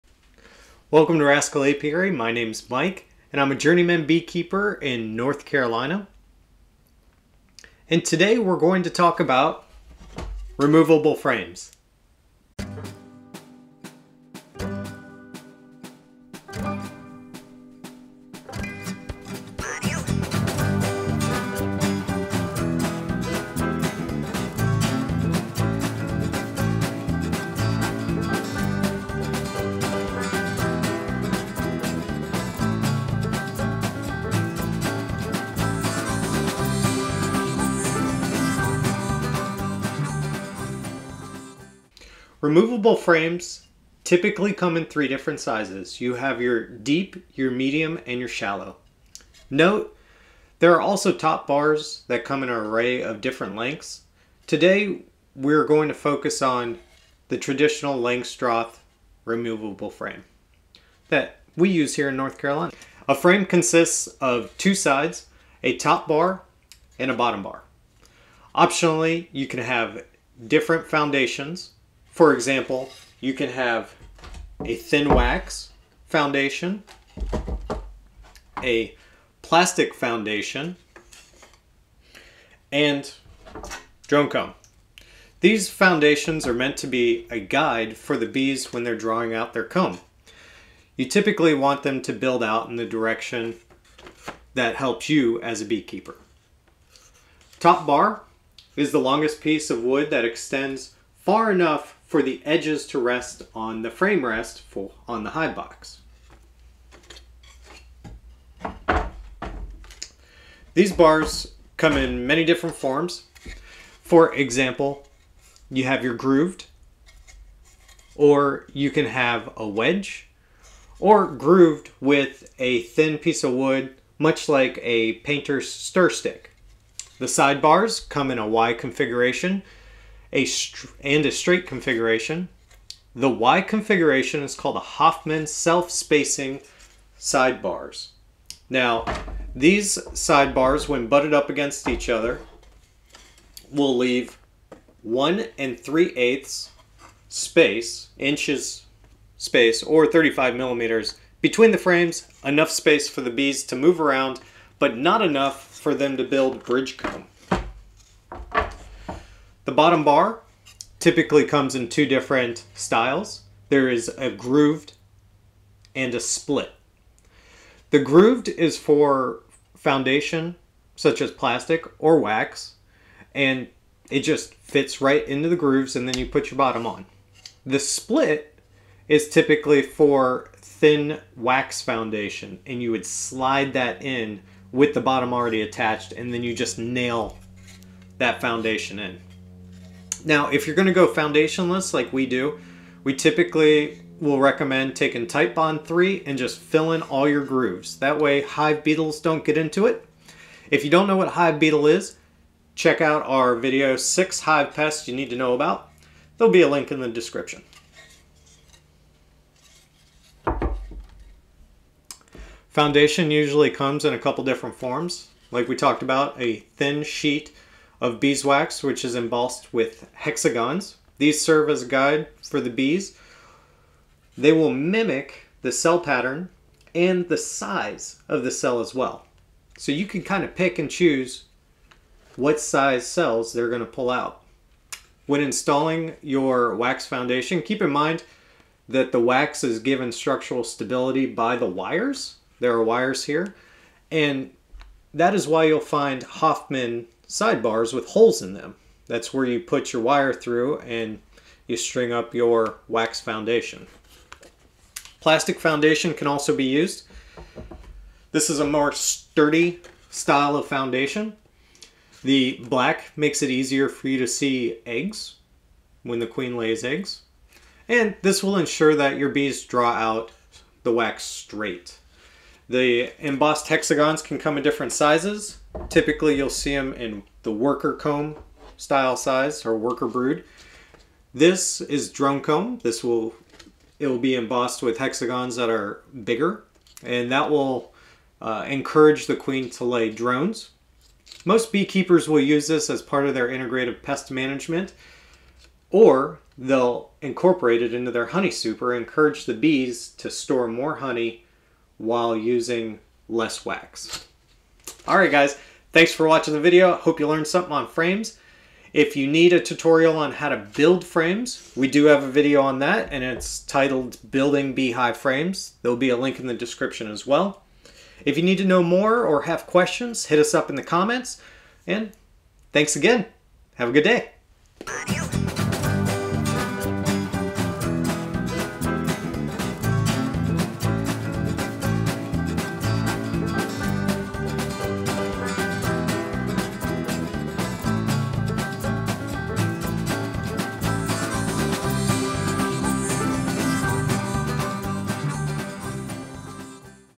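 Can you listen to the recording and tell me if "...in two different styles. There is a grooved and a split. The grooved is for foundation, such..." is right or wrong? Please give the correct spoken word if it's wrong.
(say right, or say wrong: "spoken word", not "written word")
right.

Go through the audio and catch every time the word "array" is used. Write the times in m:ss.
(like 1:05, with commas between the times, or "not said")
0:52.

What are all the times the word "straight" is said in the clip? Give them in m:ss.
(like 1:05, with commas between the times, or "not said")
2:11, 4:31.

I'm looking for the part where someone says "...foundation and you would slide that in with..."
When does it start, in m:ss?
3:01.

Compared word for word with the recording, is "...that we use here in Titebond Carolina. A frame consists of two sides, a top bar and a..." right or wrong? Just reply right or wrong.
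wrong.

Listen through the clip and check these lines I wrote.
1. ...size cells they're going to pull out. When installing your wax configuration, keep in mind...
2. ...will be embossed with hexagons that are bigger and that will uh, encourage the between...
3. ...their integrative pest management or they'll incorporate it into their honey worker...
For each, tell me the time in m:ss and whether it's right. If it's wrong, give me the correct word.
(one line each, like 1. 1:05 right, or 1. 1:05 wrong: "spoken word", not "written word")
1. 3:52 wrong: "foundation", not "configuration"
2. 4:44 wrong: "queen", not "between"
3. 4:53 wrong: "super", not "worker".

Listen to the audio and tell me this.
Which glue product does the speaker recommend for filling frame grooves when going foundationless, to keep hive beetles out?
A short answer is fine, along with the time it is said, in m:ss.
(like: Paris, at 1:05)
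Titebond 3, at 3:15.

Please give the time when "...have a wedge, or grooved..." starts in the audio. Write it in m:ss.
1:59.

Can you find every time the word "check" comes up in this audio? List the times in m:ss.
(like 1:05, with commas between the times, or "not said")
3:22.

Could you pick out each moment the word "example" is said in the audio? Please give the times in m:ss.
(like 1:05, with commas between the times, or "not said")
1:12, 1:54.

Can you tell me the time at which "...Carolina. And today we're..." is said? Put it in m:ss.
0:05.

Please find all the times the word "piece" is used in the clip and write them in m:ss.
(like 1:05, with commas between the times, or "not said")
1:39, 2:03.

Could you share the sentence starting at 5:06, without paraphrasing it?
Hope you learned something on frames.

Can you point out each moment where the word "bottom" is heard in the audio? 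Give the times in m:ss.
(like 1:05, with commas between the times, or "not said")
1:07, 2:39, 2:56, 3:05.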